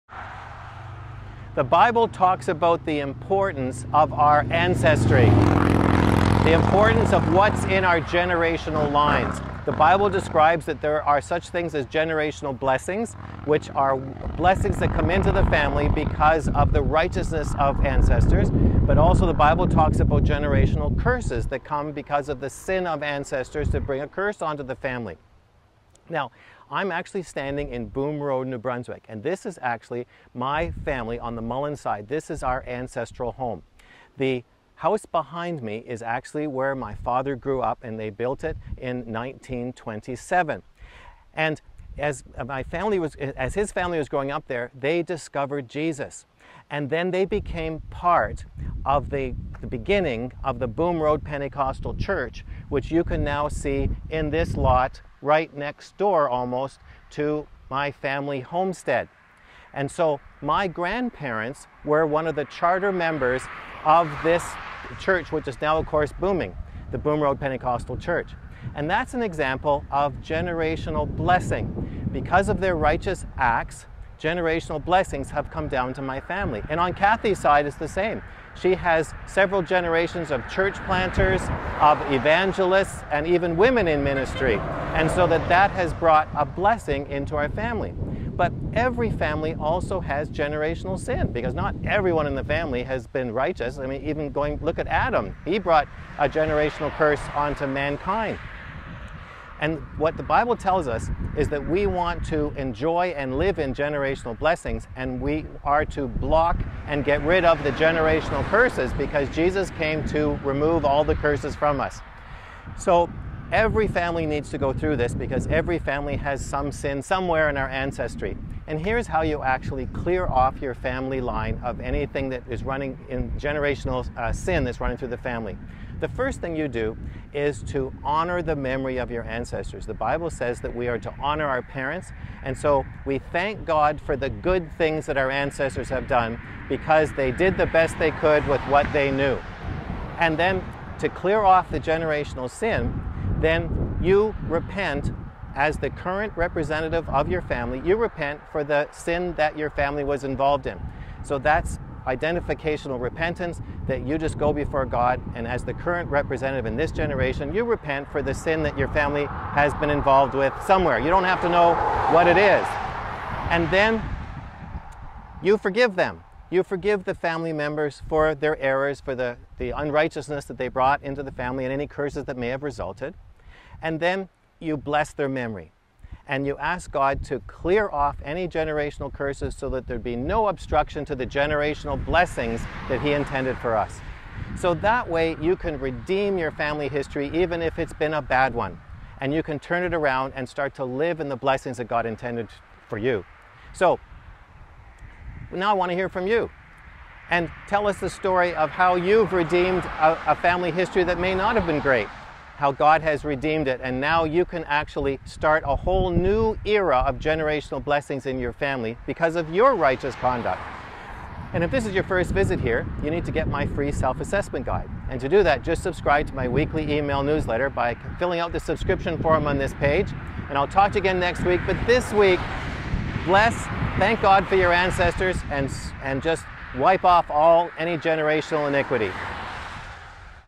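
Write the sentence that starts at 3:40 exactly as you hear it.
And I'll talk to you again next week.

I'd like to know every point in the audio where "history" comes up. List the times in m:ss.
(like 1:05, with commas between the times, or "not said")
3:06, 3:20.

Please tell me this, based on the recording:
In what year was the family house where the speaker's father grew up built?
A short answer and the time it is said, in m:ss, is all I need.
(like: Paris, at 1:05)
1927, at 0:38.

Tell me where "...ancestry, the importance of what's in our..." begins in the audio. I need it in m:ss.
0:04.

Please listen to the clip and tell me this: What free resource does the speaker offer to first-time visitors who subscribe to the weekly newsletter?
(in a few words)
self-assessment guide.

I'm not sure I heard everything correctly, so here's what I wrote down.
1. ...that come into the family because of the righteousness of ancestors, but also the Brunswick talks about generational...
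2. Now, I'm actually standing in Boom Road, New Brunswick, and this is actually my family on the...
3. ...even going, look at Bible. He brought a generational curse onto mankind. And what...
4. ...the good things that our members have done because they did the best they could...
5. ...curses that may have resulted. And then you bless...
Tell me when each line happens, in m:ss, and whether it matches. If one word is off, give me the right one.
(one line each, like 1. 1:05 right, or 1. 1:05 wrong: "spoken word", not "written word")
1. 0:14 wrong: "Bible", not "Brunswick"
2. 0:26 right
3. 1:34 wrong: "Adam", not "Bible"
4. 2:14 wrong: "ancestors", not "members"
5. 2:51 right.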